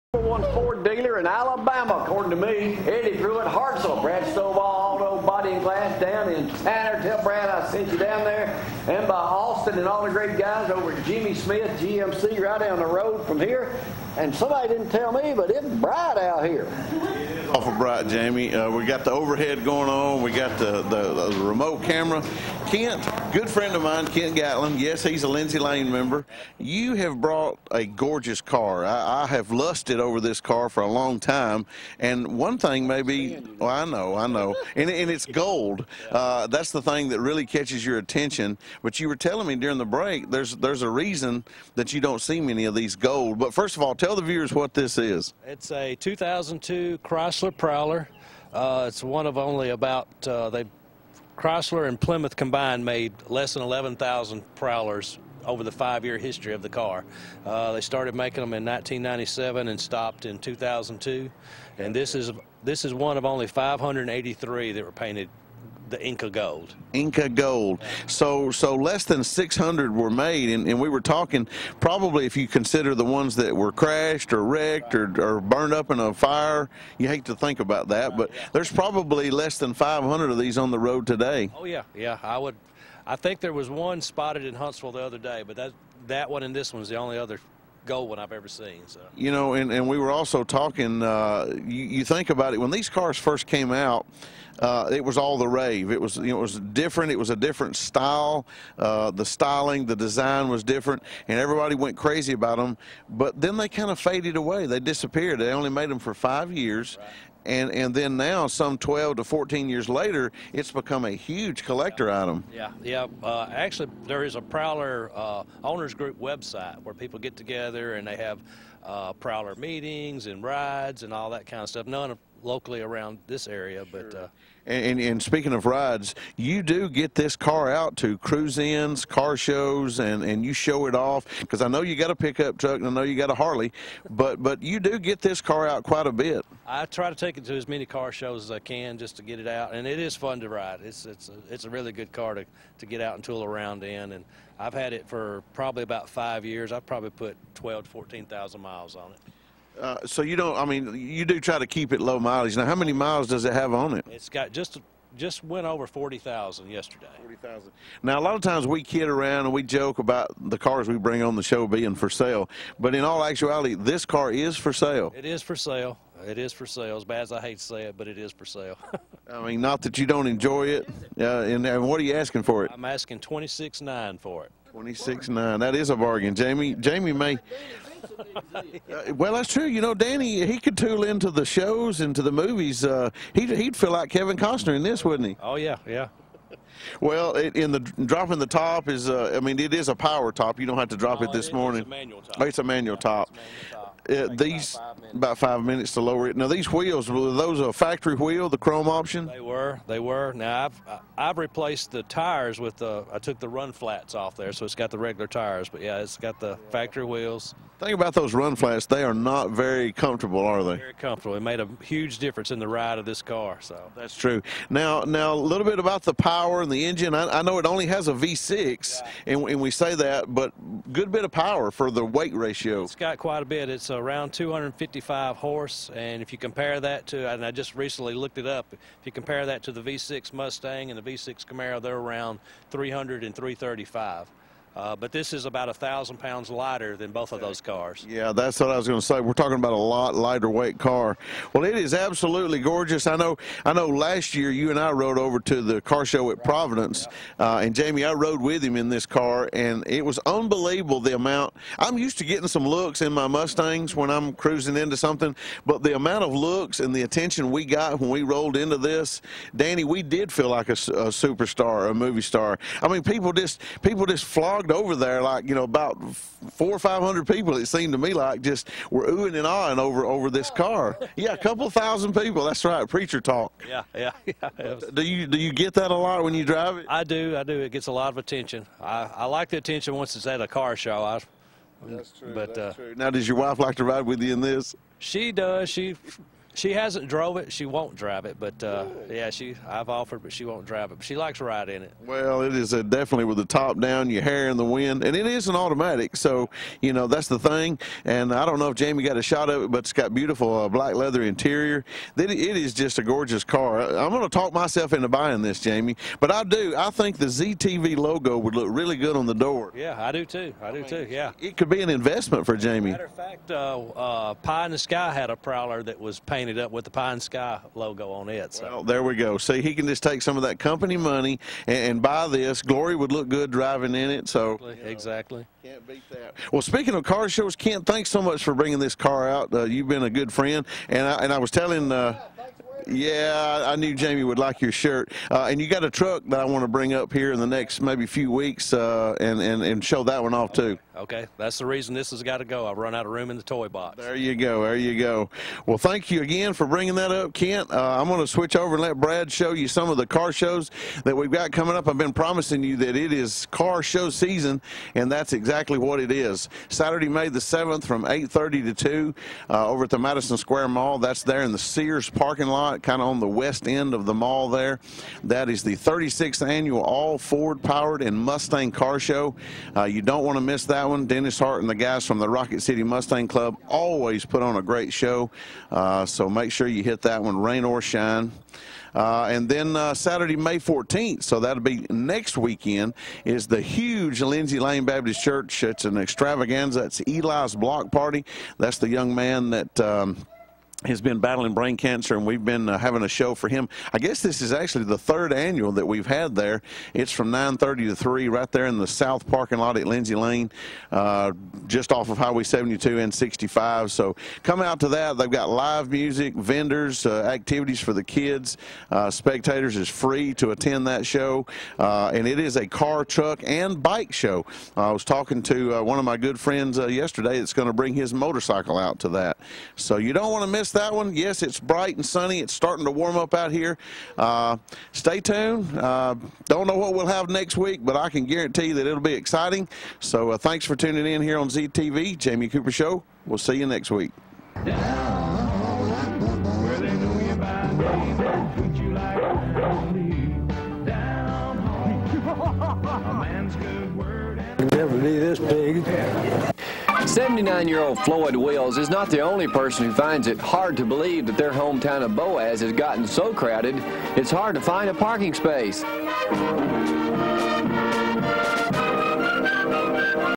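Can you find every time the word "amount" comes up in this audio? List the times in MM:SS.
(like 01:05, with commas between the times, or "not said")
04:11, 04:15.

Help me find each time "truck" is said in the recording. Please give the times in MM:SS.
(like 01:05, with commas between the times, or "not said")
02:12, 05:35, 06:53.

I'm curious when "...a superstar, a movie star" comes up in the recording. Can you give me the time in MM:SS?
04:20.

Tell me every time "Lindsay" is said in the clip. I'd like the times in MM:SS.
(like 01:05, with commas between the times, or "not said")
00:25, 06:24, 06:39.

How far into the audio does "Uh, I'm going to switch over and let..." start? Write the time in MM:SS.
05:47.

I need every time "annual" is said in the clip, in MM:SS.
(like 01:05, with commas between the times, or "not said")
06:06, 06:35.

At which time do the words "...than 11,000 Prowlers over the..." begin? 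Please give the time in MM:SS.
00:53.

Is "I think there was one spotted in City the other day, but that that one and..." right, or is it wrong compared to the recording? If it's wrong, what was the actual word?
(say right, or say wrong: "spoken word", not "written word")
wrong: "Huntsville", not "City".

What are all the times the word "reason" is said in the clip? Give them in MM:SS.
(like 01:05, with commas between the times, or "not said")
00:40, 05:41.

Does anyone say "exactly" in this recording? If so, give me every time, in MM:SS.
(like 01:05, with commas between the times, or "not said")
05:24, 05:55.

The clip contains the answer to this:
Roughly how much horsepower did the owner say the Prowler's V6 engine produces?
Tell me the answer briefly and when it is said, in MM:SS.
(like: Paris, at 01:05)
255, at 03:44.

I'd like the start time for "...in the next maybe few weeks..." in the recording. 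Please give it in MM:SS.
05:37.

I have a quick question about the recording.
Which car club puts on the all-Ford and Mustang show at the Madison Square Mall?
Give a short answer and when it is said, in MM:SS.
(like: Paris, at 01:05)
Rocket City Mustang Club, at 06:12.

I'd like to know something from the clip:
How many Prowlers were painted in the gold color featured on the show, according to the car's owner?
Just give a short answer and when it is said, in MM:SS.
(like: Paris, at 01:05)
583, at 01:03.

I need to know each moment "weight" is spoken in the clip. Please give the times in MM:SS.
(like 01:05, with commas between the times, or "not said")
03:42, 04:00.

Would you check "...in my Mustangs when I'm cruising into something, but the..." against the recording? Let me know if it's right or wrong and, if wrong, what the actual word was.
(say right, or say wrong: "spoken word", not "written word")
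right.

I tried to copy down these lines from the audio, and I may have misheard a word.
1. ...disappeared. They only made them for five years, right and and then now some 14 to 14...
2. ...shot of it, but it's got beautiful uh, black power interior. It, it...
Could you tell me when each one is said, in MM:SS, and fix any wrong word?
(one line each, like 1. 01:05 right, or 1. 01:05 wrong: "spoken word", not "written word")
1. 01:44 wrong: "12", not "14"
2. 04:59 wrong: "leather", not "power".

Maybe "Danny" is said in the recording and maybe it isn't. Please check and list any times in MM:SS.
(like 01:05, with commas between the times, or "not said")
02:59, 04:19.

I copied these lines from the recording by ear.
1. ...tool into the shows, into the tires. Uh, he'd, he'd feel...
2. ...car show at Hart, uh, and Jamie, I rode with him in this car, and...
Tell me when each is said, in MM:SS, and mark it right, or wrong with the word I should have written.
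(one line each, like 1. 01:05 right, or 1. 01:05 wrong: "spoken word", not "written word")
1. 03:00 wrong: "movies", not "tires"
2. 04:05 wrong: "Providence", not "Hart".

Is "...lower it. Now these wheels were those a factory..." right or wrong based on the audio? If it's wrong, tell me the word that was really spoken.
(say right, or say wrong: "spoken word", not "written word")
right.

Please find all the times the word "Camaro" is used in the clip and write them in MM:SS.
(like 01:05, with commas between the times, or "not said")
03:51.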